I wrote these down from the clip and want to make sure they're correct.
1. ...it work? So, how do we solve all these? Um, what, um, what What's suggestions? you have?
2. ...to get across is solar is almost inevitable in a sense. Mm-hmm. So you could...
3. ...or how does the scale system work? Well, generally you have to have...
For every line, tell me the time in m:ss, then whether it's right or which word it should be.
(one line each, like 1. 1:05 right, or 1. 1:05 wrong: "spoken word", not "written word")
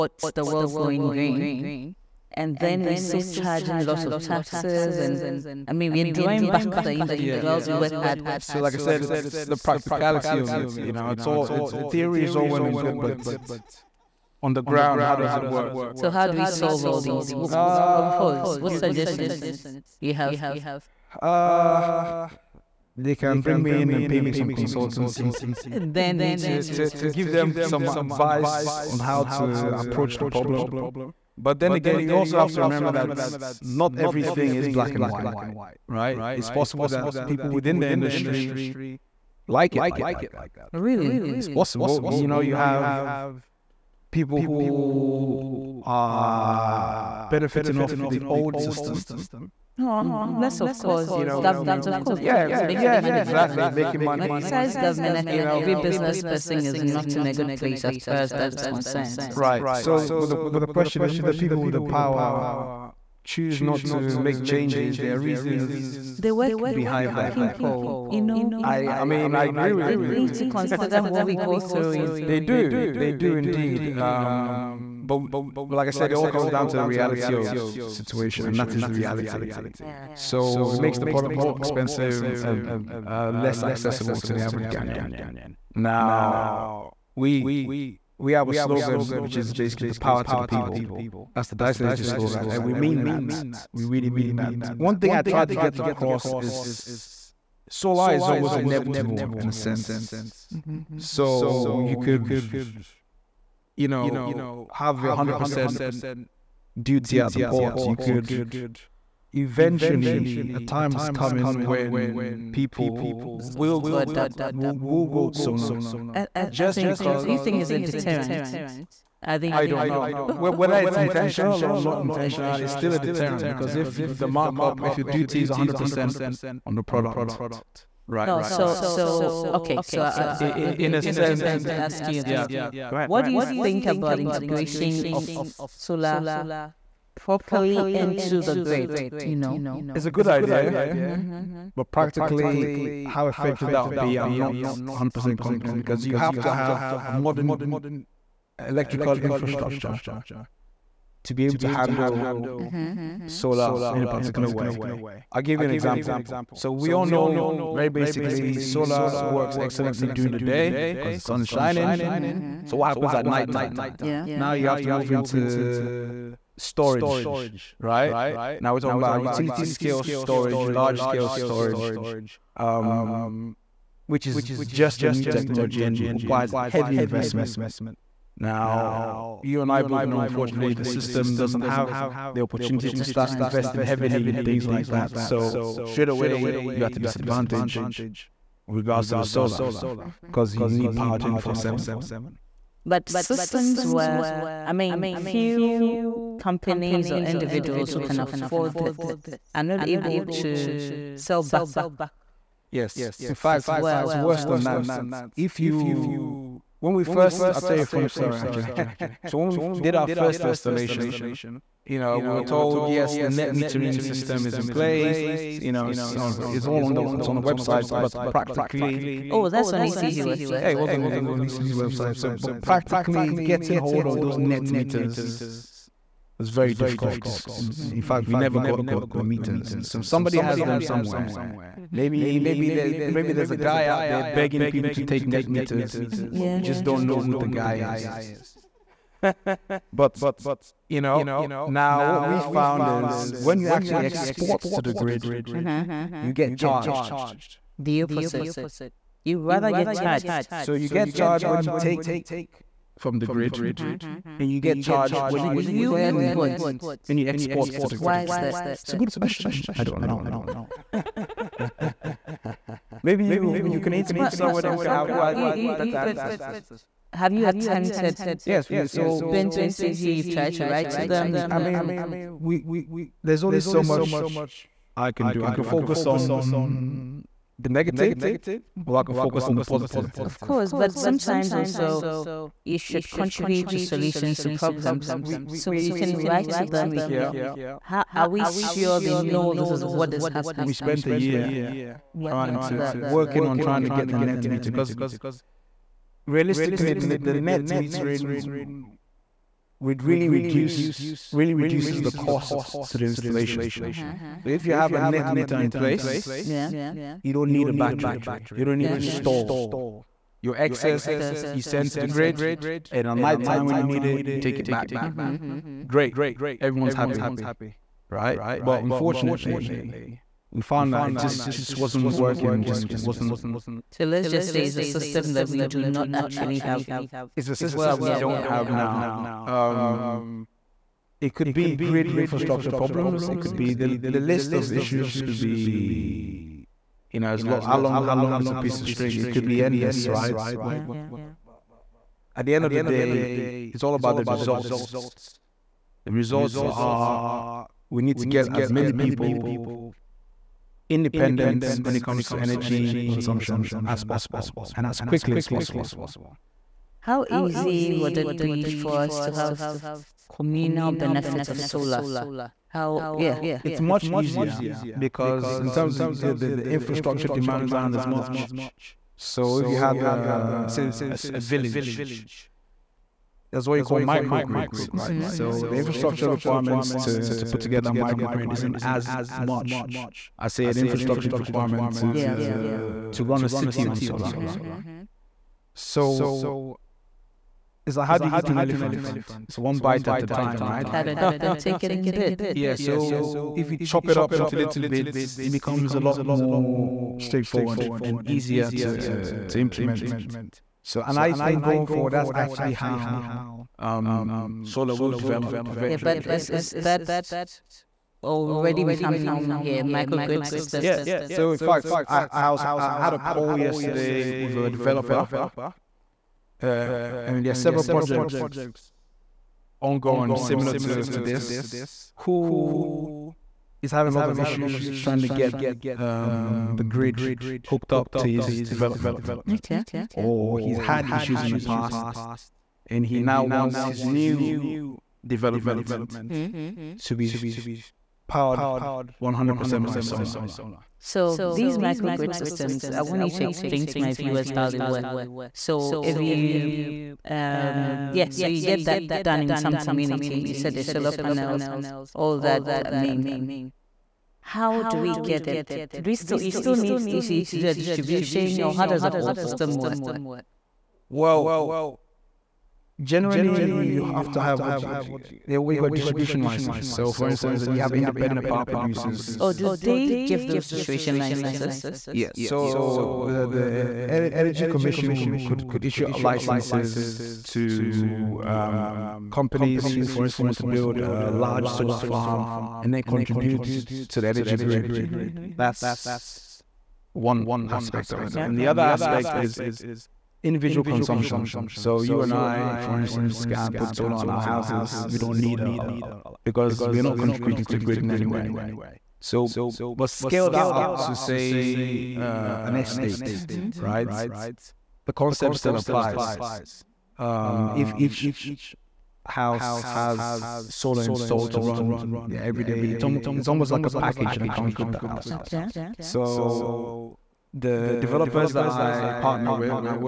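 1. 0:15 right
2. 1:35 right
3. 7:38 wrong: "whole", not "scale".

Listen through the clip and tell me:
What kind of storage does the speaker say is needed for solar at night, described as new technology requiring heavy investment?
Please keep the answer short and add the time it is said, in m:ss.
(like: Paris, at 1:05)
Utility scale storage, at 2:49.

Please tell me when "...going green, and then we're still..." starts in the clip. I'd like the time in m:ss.
0:00.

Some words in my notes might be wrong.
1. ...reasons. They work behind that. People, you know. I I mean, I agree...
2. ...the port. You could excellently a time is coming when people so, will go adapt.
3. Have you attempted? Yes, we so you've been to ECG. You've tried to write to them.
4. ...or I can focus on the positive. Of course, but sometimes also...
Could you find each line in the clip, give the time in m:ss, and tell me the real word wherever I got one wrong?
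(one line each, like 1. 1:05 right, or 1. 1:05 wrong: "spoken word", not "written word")
1. 1:05 right
2. 1:47 wrong: "eventually", not "excellently"
3. 4:27 right
4. 4:38 right.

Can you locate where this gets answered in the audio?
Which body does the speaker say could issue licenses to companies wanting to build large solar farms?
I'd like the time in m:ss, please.
7:54.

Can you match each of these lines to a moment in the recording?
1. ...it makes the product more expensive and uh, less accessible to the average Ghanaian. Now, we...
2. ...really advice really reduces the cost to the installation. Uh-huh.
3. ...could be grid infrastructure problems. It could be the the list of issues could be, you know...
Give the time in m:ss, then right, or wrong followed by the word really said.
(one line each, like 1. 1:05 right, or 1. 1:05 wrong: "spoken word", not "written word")
1. 1:20 right
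2. 5:00 wrong: "reduce", not "advice"
3. 5:31 right.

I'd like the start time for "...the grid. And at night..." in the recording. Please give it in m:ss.
5:11.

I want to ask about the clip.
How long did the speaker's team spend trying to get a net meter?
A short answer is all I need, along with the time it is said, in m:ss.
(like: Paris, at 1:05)
A year, at 4:51.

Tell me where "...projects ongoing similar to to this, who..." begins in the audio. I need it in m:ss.
6:57.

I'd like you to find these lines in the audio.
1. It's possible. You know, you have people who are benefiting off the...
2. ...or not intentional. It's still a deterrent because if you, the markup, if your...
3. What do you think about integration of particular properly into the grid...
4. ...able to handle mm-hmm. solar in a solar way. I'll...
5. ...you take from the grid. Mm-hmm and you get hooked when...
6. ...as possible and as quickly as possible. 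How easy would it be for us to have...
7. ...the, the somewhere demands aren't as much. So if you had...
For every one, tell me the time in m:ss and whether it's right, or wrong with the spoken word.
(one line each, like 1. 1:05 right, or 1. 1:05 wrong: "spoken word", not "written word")
1. 0:41 right
2. 2:01 right
3. 2:13 wrong: "solar", not "particular"
4. 2:31 wrong: "particular", not "solar"
5. 4:11 wrong: "charged", not "hooked"
6. 5:53 right
7. 6:06 wrong: "infrastructure", not "somewhere".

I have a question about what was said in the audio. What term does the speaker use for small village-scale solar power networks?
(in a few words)
Microgrids.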